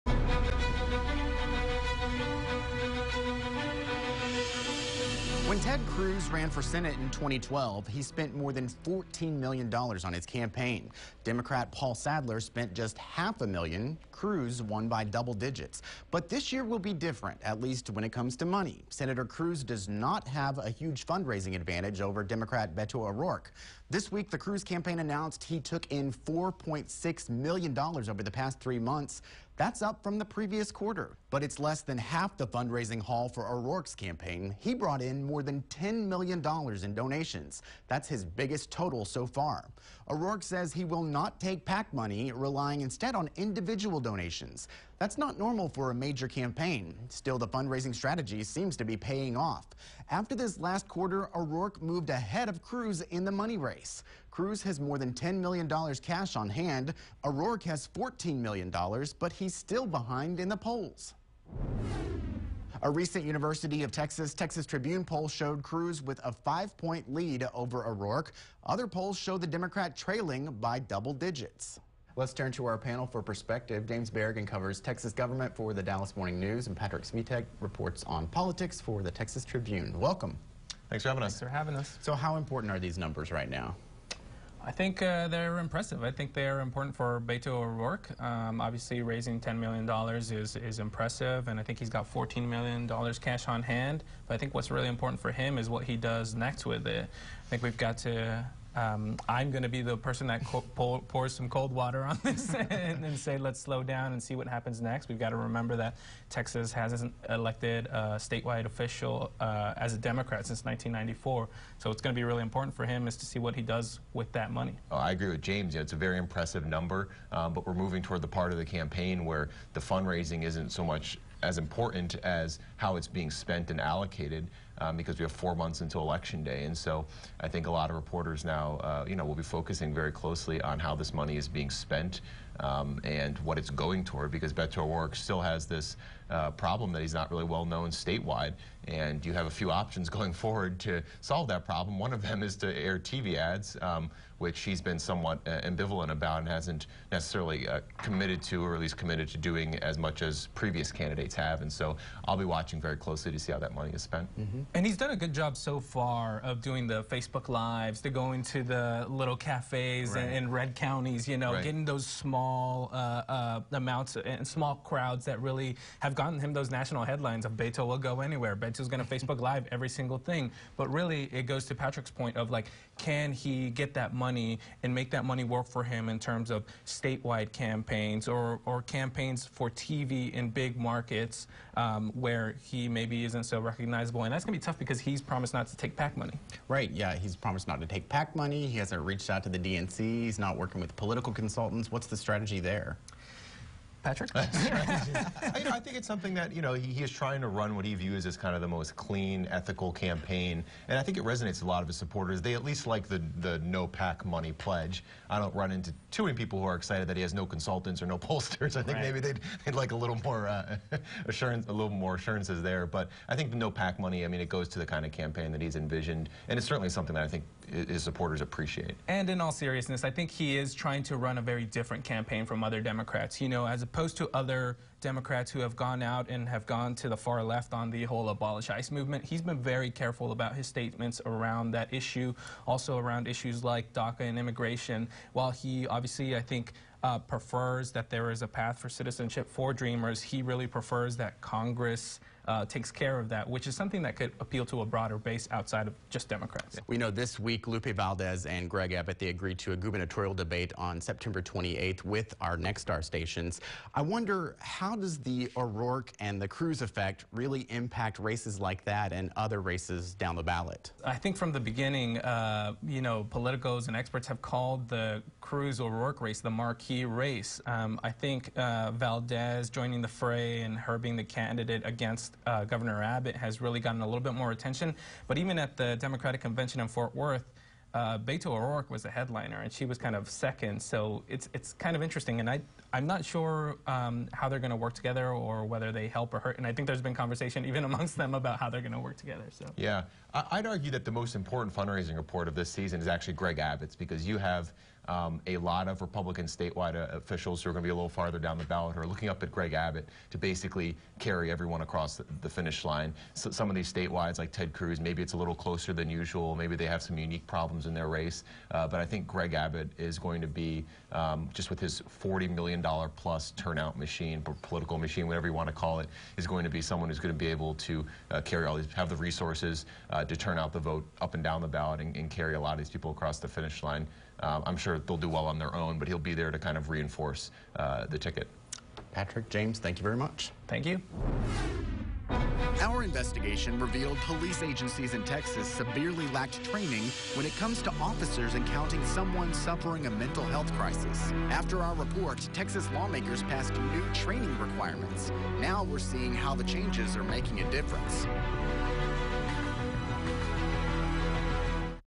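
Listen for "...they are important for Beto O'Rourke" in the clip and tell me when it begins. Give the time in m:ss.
1:26.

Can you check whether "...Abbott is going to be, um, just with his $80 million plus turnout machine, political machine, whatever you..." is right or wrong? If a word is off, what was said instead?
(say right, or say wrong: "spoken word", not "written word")
wrong: "40", not "80".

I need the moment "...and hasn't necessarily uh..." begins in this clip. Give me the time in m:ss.
2:26.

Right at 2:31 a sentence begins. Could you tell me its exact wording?
And so I'll be watching very closely to see how that money is spent.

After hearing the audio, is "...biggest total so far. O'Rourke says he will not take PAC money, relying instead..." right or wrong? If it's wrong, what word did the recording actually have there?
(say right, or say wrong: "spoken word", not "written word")
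right.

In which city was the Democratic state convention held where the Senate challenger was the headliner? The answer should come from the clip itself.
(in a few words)
Fort Worth.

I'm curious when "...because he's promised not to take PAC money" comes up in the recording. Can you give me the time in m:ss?
3:04.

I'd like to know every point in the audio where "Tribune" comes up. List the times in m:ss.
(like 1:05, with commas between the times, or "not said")
1:04, 1:19.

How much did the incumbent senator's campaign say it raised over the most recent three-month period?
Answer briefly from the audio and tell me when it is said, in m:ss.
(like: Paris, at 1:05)
$4.6 million, at 0:26.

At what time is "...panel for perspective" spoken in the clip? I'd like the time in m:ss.
1:12.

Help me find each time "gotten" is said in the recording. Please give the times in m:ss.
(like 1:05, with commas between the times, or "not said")
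2:46, 4:33.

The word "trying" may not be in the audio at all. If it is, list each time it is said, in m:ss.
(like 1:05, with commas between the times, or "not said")
3:17, 3:40.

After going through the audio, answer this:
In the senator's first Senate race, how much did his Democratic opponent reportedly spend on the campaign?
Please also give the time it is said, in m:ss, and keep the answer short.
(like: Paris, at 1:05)
half a million, at 0:12.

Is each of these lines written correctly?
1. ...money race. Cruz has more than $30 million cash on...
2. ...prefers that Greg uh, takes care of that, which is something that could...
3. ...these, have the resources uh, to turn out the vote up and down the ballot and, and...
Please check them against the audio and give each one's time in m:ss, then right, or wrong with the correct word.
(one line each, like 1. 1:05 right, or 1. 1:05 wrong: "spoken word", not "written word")
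1. 0:53 wrong: "10", not "30"
2. 4:00 wrong: "Congress", not "Greg"
3. 5:18 right.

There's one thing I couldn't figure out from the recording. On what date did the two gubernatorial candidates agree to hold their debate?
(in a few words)
September 28th.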